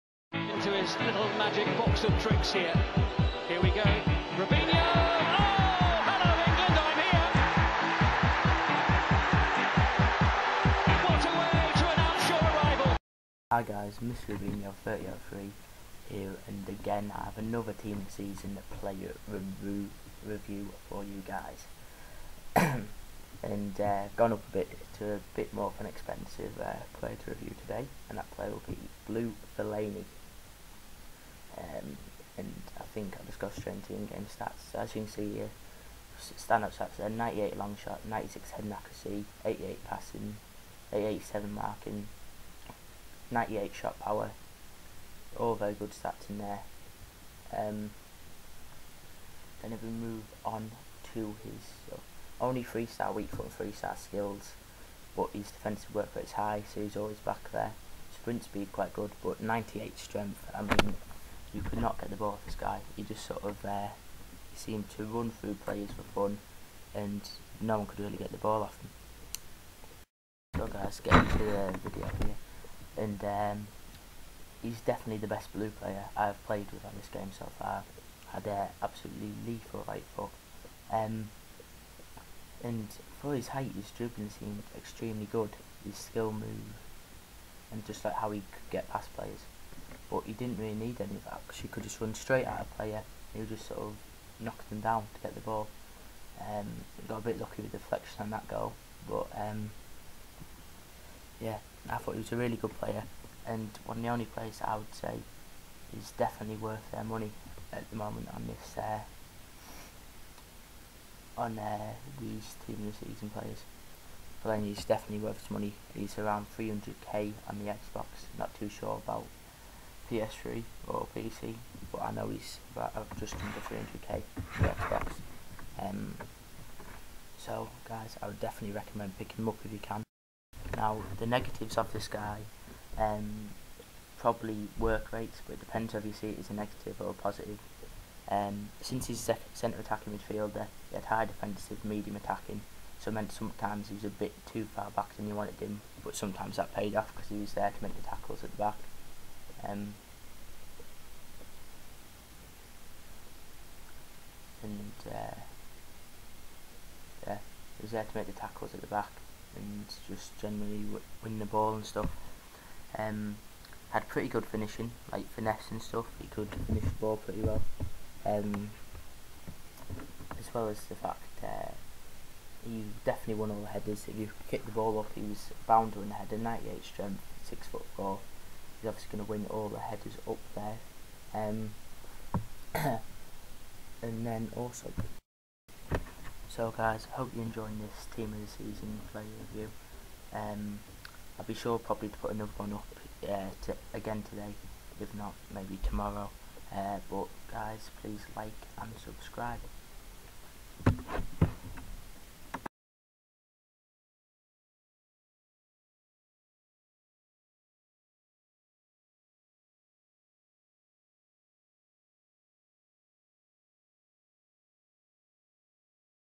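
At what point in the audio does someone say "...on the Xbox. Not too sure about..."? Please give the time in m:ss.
1:57.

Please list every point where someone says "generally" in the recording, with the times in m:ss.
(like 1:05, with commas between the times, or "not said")
2:40.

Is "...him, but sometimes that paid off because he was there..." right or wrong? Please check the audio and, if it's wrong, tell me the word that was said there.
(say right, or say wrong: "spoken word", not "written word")
right.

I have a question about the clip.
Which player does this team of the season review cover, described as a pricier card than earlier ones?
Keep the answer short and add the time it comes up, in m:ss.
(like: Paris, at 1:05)
Fellaini, at 0:29.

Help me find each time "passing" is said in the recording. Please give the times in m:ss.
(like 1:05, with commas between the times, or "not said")
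0:39.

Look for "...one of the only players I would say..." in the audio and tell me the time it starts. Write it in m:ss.
1:43.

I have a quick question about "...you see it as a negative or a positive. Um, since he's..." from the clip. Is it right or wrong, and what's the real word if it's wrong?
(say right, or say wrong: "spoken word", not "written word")
right.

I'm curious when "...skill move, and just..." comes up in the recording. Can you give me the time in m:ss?
1:25.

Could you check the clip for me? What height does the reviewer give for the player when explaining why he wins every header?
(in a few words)
6 foot 4.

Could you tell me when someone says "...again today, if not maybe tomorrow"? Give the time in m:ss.
3:13.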